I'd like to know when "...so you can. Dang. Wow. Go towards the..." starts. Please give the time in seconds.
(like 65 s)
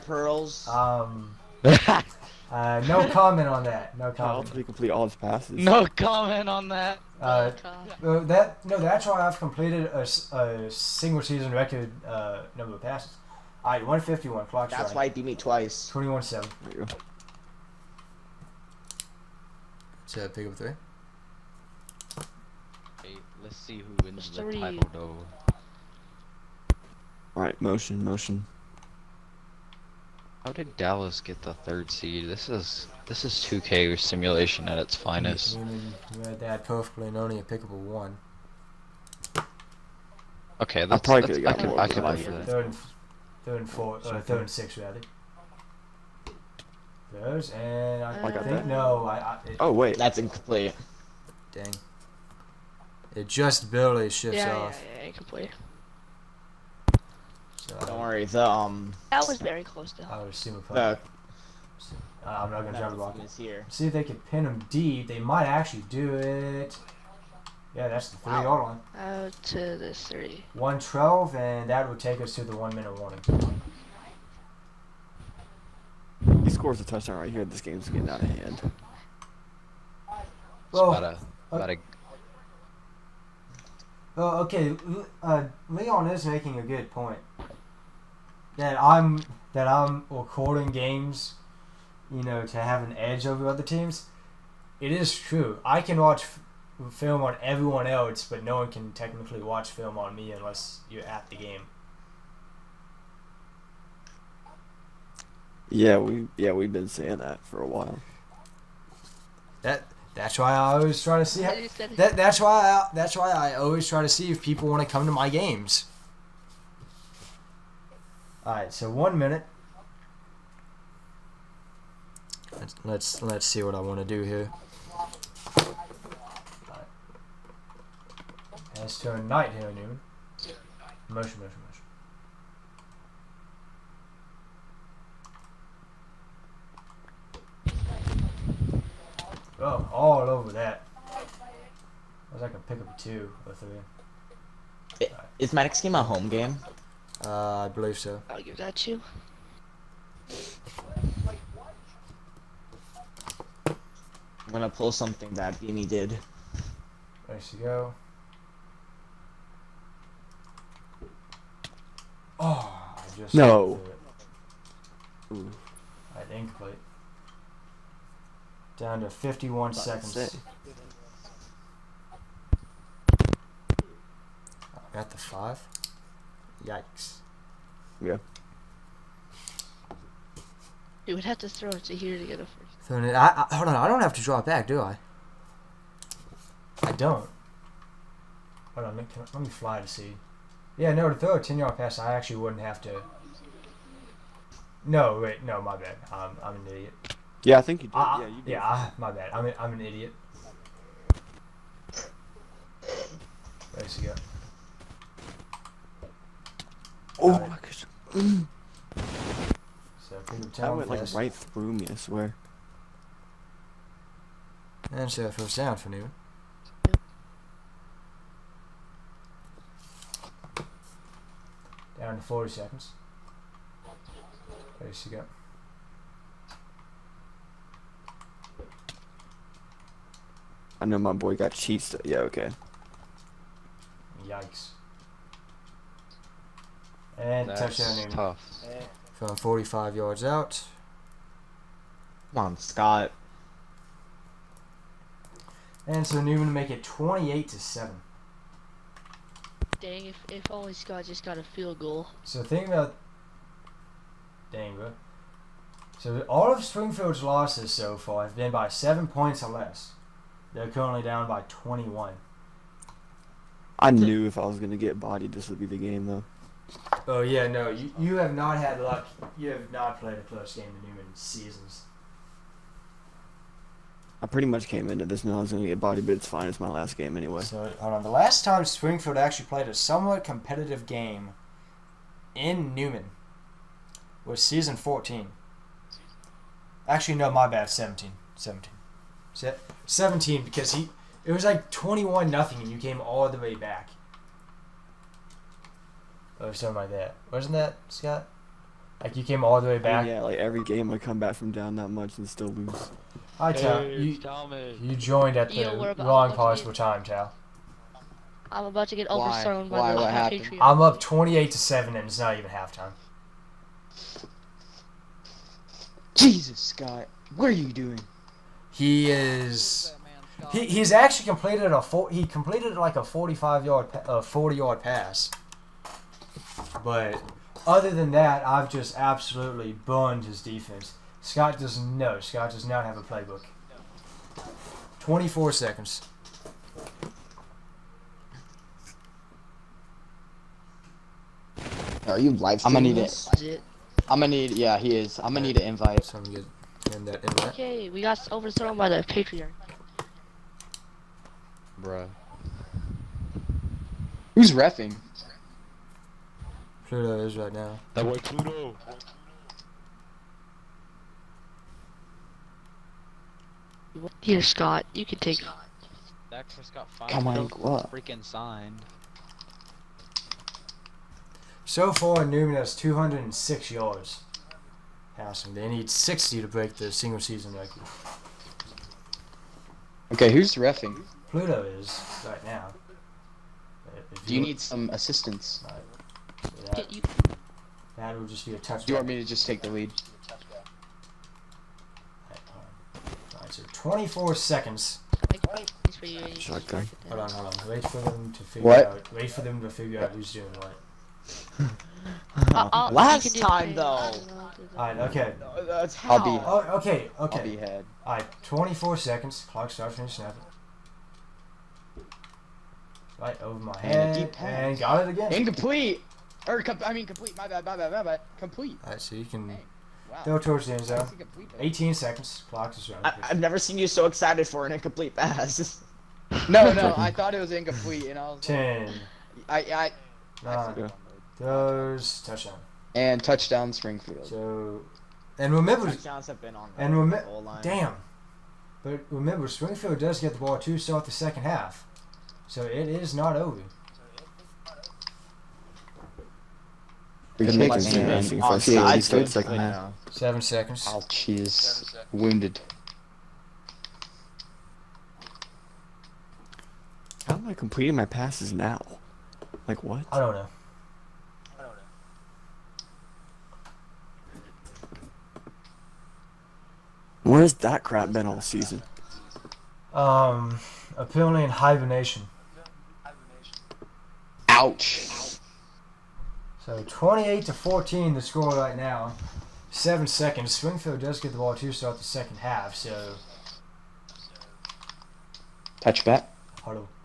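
419 s.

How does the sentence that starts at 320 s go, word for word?
He, he's actually completed a four, he completed like a 45 yard a 40 yard pass.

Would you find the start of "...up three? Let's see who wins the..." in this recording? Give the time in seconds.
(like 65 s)
20 s.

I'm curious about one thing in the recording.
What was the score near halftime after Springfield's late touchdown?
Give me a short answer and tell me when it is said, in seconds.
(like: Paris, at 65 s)
28 to 14, at 476 s.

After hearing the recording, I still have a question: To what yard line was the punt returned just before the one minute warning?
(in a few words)
3.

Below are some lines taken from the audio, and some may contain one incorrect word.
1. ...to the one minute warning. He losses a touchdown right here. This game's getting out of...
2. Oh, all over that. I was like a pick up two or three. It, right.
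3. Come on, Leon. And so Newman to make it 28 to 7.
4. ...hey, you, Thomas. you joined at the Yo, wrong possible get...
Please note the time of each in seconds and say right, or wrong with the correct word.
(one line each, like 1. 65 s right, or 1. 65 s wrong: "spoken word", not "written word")
1. 72 s wrong: "scores", not "losses"
2. 139 s right
3. 242 s wrong: "Scott", not "Leon"
4. 303 s right.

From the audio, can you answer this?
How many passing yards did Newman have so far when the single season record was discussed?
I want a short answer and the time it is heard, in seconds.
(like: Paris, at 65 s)
206, at 372 s.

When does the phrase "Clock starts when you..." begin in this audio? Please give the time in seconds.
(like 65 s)
409 s.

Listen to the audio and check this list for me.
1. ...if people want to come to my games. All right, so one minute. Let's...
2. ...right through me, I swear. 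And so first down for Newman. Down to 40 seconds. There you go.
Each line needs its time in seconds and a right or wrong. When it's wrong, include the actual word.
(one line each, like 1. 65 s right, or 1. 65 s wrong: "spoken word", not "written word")
1. 114 s right
2. 211 s right.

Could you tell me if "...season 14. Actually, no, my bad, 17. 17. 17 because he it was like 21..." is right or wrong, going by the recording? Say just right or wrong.
right.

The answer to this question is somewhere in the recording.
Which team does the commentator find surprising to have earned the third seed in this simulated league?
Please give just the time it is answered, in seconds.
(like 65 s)
30 s.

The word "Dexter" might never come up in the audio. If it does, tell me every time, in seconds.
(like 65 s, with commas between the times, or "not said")
366 s.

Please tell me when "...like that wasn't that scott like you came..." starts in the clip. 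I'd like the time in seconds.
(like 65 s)
296 s.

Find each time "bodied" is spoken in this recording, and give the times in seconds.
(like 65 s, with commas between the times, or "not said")
264 s, 275 s.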